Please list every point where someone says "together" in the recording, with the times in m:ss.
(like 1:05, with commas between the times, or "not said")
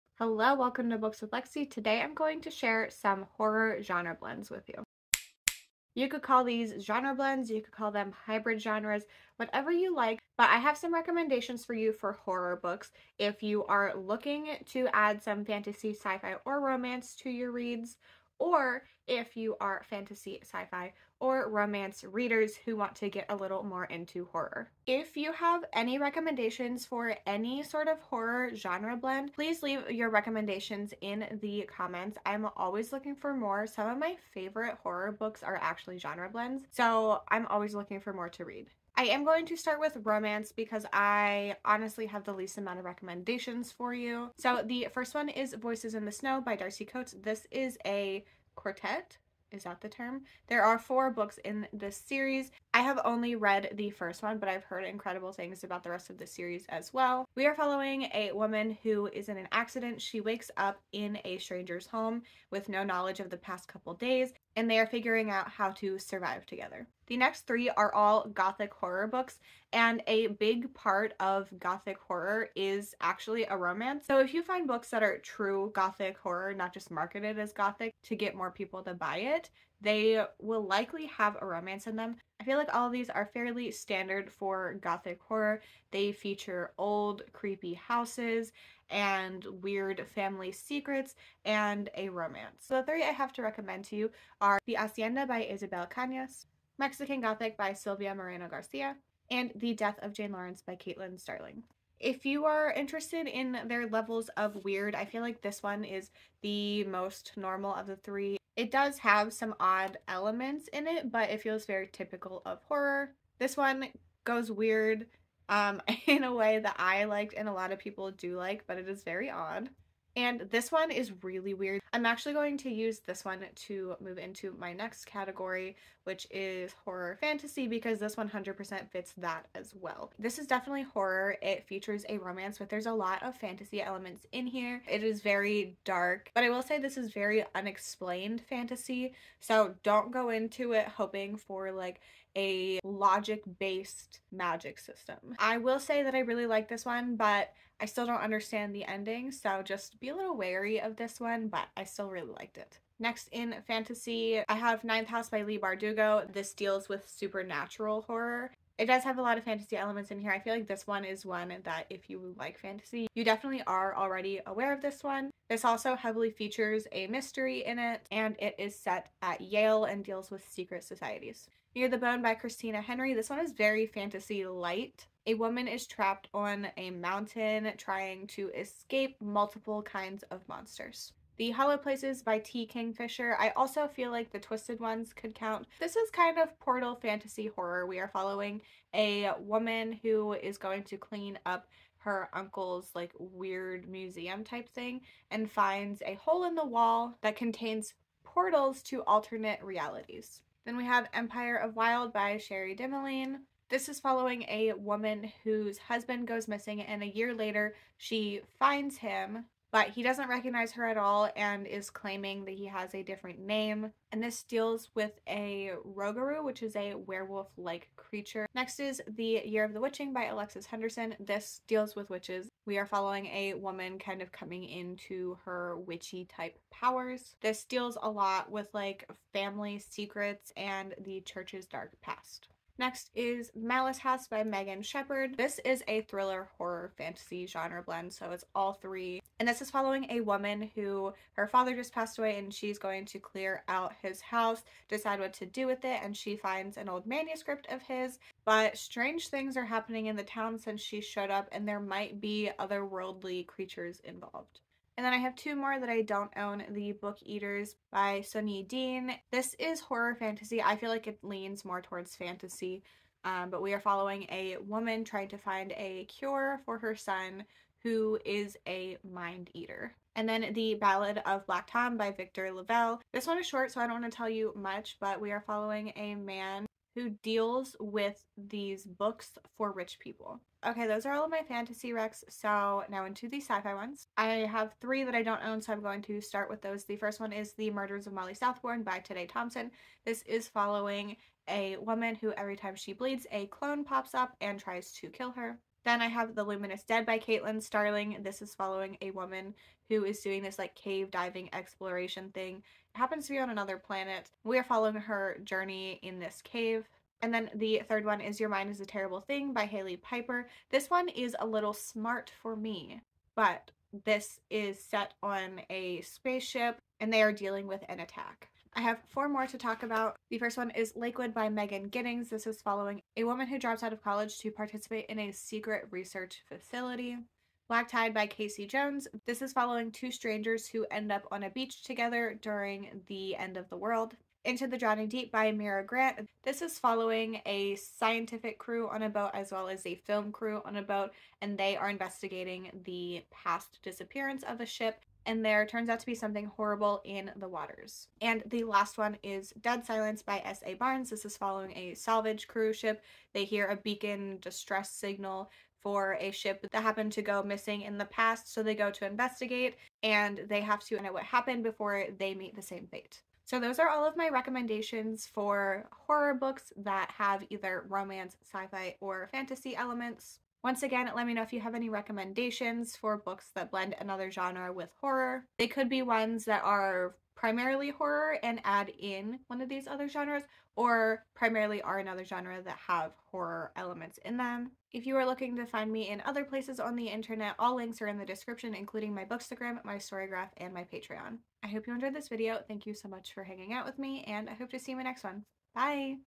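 1:06, 5:31.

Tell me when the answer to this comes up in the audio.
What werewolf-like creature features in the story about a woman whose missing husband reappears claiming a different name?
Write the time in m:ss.
3:35.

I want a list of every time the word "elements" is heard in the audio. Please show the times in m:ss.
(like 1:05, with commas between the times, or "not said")
1:50, 2:13, 2:39, 6:09, 6:23.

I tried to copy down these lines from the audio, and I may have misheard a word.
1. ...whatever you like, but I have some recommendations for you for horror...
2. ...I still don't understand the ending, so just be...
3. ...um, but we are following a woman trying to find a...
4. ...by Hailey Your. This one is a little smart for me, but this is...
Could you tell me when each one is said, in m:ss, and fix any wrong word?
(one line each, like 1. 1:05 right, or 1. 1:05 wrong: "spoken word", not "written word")
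1. 0:09 right
2. 2:27 right
3. 4:23 right
4. 5:09 wrong: "Piper", not "Your".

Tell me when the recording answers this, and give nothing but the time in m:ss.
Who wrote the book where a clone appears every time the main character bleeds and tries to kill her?
4:48.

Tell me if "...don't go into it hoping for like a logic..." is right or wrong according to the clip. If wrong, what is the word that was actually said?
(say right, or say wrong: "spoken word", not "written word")
right.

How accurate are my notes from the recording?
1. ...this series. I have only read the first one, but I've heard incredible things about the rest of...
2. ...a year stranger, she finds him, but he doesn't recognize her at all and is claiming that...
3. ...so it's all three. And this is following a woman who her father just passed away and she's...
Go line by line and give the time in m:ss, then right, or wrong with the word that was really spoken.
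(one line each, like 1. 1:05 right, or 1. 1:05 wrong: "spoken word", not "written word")
1. 0:51 right
2. 3:27 wrong: "later", not "stranger"
3. 3:58 right.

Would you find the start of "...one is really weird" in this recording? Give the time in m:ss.
2:00.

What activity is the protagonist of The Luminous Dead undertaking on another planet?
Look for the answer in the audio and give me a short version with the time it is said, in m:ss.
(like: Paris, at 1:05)
Cave diving exploration, at 5:00.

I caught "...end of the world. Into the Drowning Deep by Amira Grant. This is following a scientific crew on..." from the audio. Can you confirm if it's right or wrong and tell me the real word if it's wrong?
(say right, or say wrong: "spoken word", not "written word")
right.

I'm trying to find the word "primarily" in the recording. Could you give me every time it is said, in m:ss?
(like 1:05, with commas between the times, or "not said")
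6:17, 6:21.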